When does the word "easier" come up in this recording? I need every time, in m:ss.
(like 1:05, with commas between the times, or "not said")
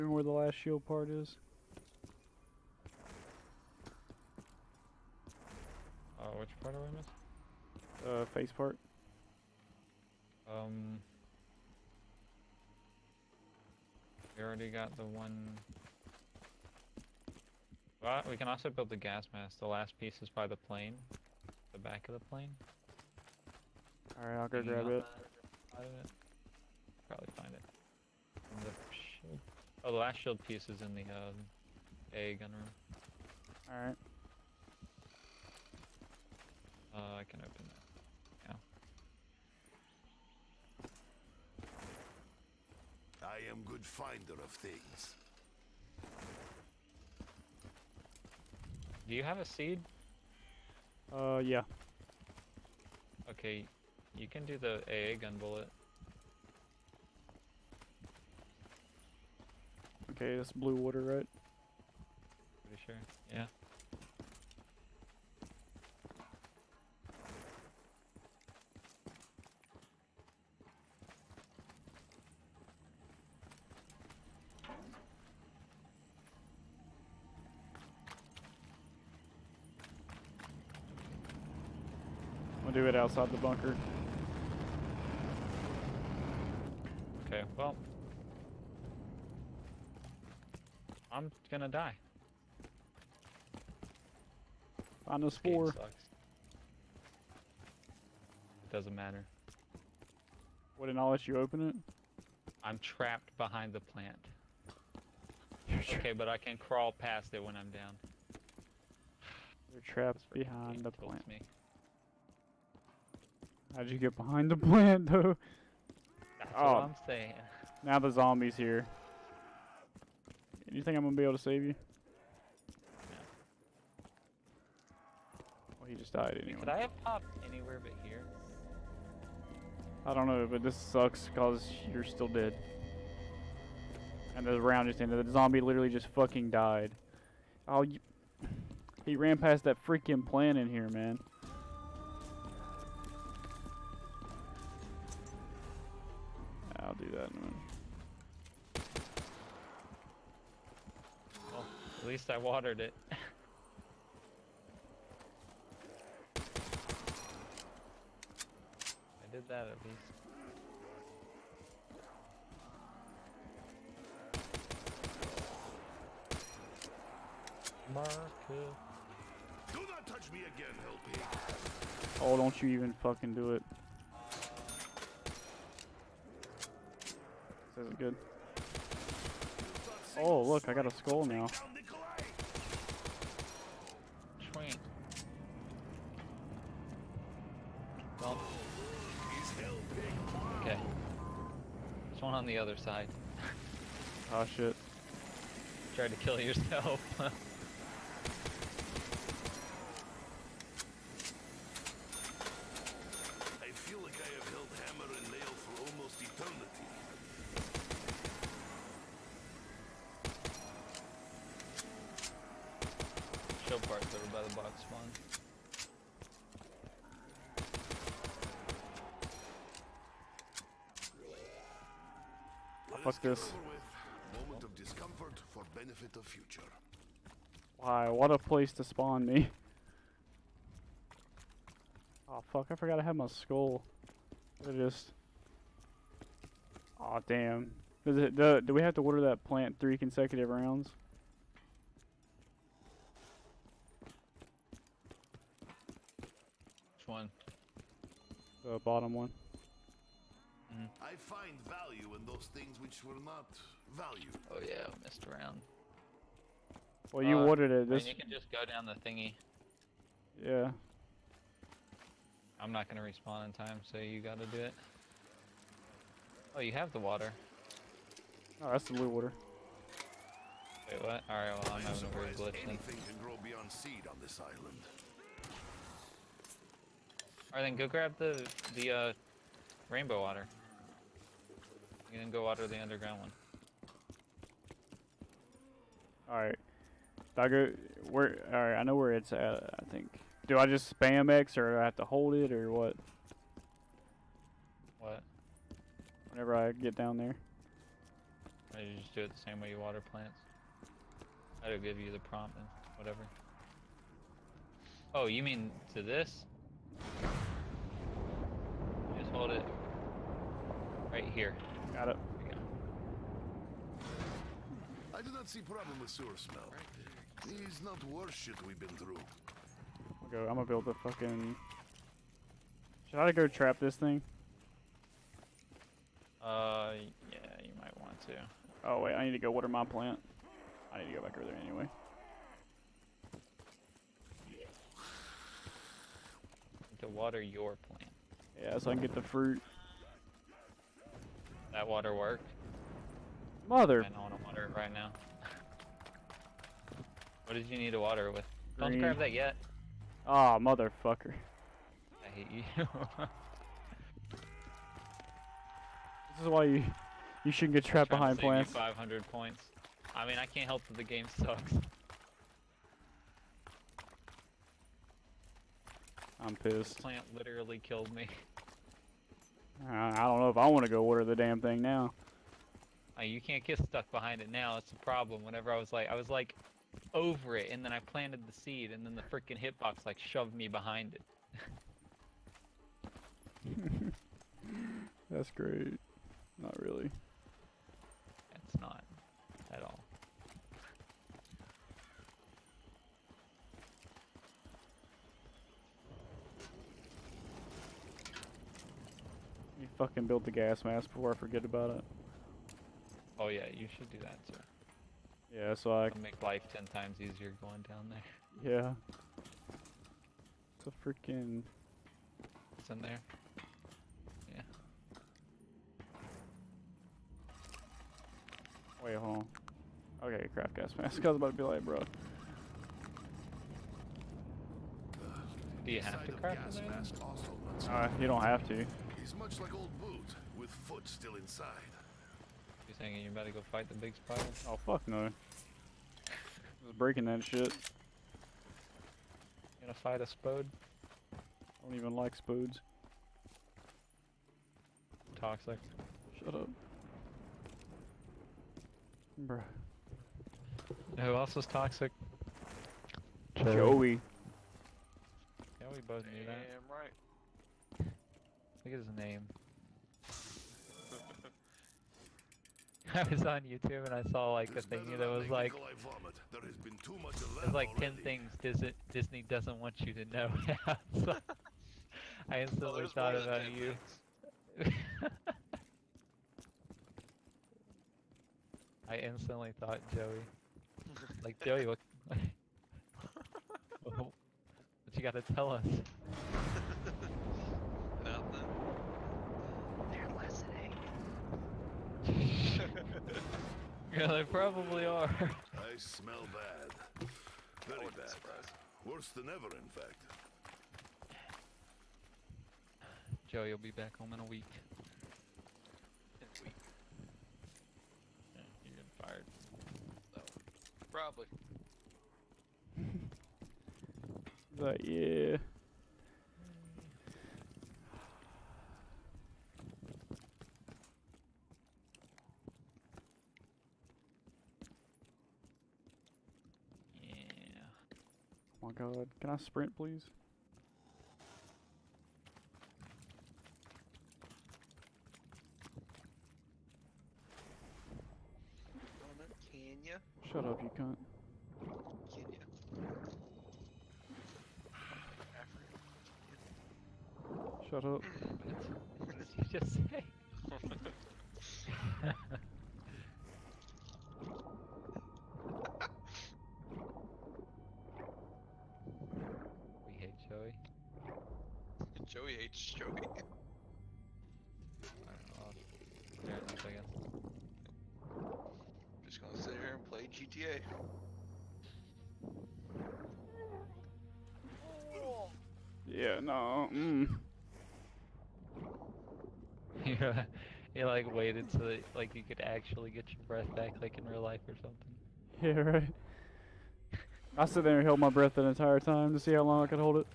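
6:47.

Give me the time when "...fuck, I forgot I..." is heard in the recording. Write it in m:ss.
3:52.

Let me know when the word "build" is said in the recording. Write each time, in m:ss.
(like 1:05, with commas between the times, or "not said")
0:18, 5:20, 6:40.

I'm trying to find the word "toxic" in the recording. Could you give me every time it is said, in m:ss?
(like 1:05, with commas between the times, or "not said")
7:25, 7:31.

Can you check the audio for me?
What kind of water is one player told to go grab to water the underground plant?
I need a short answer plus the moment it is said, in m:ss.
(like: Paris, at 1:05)
Rainbow water, at 4:39.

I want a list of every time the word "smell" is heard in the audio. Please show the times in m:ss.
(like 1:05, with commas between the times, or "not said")
5:16, 8:15.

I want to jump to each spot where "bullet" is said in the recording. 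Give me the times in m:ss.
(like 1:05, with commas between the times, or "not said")
0:55.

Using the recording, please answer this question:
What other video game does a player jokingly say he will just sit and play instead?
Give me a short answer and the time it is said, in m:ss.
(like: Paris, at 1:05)
GTA, at 9:30.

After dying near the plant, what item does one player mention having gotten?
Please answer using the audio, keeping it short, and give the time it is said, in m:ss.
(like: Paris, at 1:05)
A skull, at 3:00.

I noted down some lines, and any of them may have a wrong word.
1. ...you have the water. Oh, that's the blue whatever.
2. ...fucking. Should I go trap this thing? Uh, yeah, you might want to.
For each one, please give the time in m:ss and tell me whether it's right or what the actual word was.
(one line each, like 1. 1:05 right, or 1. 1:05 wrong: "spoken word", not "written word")
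1. 4:26 wrong: "water", not "whatever"
2. 5:20 right.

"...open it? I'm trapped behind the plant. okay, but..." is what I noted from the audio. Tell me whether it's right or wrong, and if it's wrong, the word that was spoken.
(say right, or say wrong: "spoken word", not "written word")
right.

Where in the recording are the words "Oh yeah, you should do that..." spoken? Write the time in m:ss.
6:43.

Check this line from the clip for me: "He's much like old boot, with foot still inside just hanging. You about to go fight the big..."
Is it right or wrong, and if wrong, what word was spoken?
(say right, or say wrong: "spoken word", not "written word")
right.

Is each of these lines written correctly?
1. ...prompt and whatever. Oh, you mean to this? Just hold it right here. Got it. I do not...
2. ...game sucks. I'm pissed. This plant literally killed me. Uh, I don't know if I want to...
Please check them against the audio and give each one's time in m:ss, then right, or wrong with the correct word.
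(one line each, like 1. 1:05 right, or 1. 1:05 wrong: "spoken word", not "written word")
1. 5:02 right
2. 6:01 right.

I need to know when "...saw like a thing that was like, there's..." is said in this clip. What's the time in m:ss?
7:44.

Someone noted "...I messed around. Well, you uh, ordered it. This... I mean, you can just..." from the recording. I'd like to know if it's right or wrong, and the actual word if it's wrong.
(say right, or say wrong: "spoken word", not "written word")
right.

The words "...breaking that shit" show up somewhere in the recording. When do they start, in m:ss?
7:16.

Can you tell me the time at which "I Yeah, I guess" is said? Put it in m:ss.
9:25.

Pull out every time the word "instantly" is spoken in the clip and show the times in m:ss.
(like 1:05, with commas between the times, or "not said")
7:52, 7:59.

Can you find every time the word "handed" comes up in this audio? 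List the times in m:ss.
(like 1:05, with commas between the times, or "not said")
not said.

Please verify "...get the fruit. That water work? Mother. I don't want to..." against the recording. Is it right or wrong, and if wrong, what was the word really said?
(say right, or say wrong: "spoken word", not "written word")
right.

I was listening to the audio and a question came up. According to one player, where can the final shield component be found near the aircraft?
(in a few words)
The back of the plane.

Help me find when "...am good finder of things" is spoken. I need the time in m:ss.
0:43.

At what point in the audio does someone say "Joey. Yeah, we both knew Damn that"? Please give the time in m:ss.
7:33.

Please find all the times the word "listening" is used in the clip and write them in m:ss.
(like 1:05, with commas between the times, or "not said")
8:10.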